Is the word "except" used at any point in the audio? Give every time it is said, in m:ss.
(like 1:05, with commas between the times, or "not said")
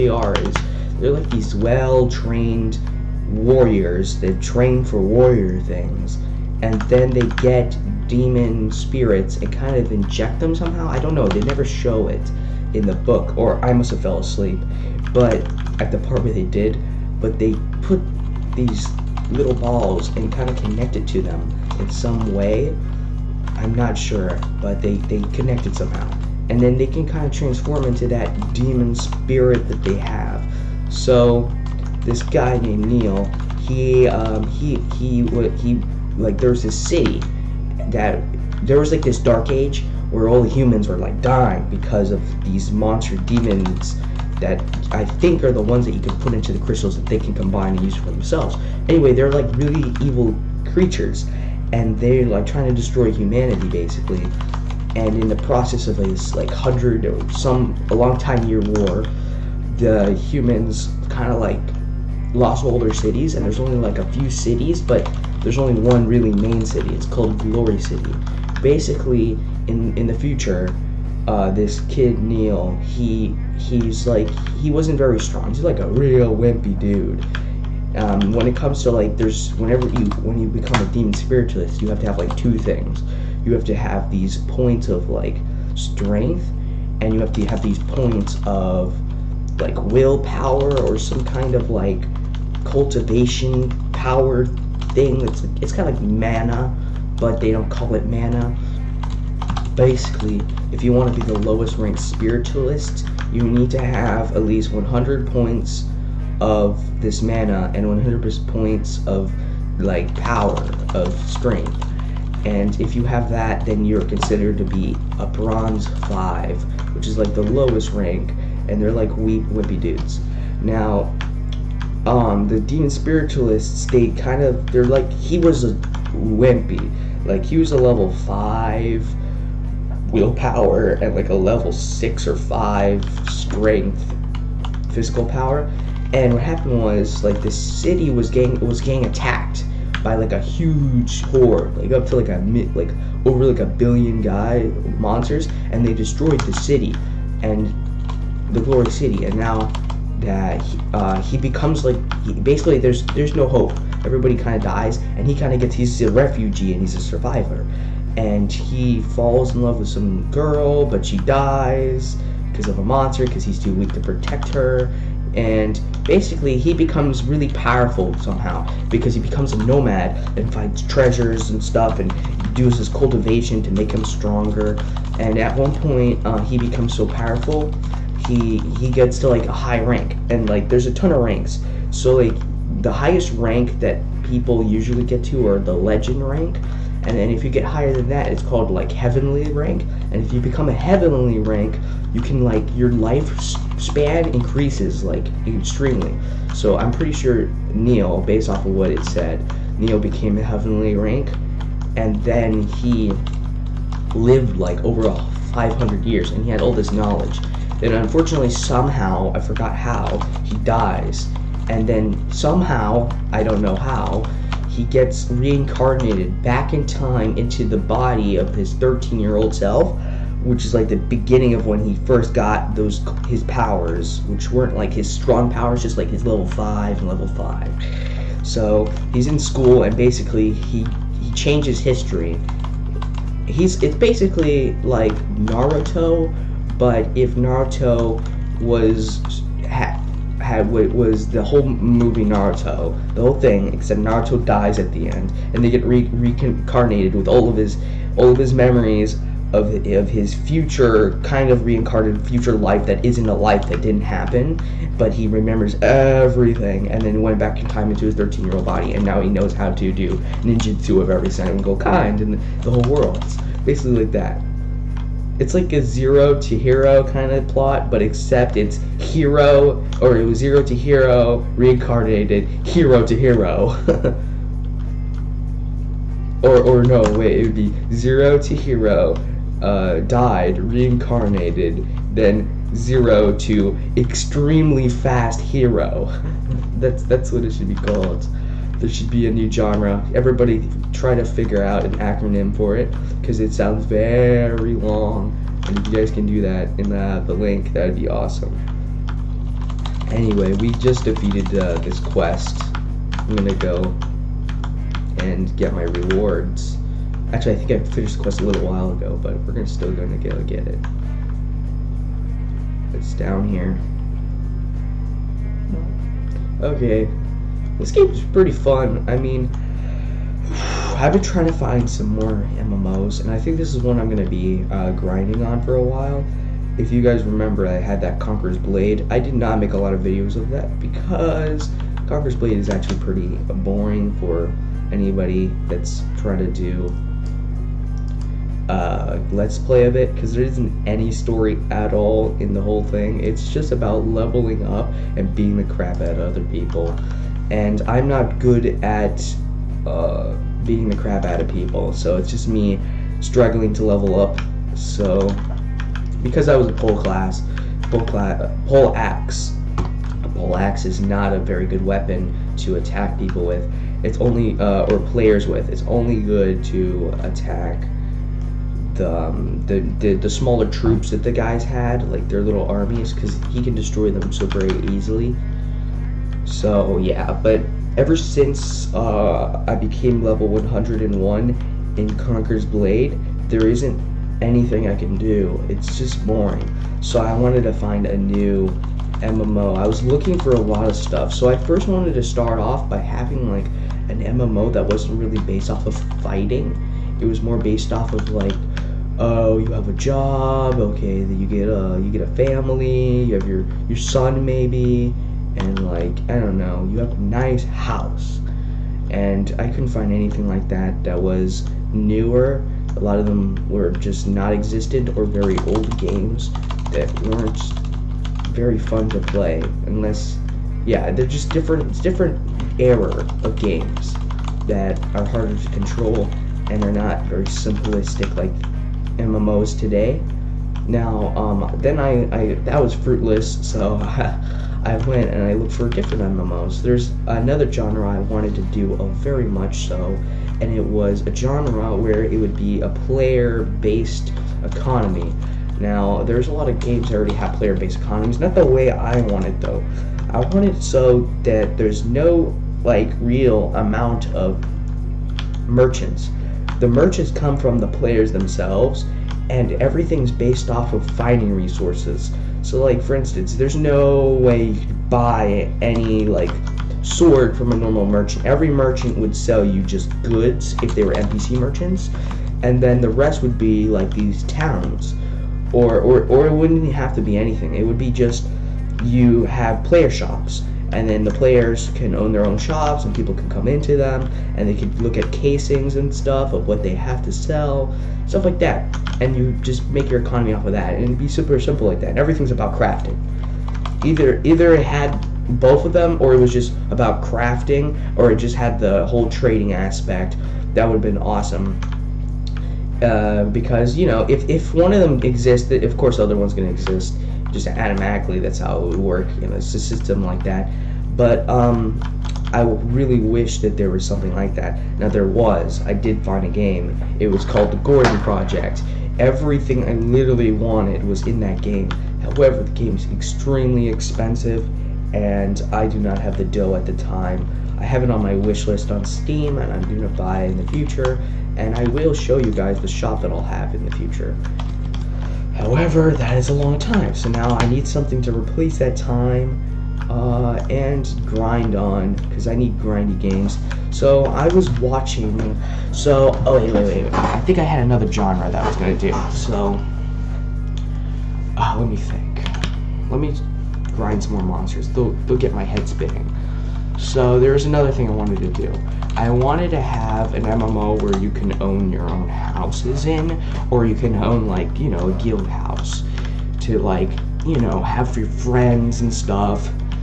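4:03, 4:28.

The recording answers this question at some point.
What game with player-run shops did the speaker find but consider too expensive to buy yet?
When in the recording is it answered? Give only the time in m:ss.
8:37.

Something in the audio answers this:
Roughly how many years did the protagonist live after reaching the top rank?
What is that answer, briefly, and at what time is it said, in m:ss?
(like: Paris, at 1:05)
500, at 3:25.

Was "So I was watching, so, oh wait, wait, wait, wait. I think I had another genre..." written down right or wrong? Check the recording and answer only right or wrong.
right.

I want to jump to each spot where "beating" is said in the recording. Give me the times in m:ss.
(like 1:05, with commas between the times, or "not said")
5:45, 5:50.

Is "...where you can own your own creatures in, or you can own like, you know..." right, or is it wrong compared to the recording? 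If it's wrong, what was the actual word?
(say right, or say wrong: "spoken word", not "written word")
wrong: "houses", not "creatures".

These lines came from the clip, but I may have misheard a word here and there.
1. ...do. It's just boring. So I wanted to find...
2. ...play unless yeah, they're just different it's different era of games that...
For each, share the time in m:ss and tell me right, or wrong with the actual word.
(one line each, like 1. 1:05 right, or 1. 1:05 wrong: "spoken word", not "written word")
1. 6:25 right
2. 6:59 right.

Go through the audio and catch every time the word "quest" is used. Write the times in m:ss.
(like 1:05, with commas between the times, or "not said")
5:01, 5:08.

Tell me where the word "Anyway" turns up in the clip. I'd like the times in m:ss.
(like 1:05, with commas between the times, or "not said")
0:48, 5:00.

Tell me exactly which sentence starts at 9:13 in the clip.
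Let me grind some more monsters.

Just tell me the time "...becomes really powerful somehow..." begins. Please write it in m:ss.
2:46.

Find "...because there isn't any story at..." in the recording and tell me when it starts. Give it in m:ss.
5:40.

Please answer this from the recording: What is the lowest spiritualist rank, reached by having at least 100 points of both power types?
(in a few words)
Bronze 5.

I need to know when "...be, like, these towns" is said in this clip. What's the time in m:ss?
7:53.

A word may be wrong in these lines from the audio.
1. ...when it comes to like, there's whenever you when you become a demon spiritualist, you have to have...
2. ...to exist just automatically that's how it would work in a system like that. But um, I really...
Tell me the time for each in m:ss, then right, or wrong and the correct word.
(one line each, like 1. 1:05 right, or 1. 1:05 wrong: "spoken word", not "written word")
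1. 1:18 right
2. 8:26 right.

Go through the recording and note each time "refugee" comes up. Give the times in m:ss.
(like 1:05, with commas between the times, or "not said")
2:36.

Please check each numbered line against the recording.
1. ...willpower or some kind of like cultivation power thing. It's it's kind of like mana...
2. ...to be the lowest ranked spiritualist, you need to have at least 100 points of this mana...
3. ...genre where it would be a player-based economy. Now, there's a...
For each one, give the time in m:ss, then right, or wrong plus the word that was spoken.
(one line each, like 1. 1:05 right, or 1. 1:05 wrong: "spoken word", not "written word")
1. 1:29 right
2. 1:41 right
3. 7:21 right.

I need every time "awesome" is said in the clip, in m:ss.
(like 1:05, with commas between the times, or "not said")
4:58, 8:21.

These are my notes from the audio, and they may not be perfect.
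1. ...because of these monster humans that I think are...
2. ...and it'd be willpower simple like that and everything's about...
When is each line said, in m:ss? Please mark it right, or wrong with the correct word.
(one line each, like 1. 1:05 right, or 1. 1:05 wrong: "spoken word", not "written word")
1. 0:41 wrong: "demons", not "humans"
2. 8:10 wrong: "super", not "willpower".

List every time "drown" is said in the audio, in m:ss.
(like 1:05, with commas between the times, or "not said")
not said.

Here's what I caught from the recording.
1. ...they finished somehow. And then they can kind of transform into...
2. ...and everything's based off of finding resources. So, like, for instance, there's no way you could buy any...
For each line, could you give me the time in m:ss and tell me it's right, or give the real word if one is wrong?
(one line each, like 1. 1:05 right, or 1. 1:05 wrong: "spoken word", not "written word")
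1. 0:24 wrong: "connected", not "finished"
2. 7:39 right.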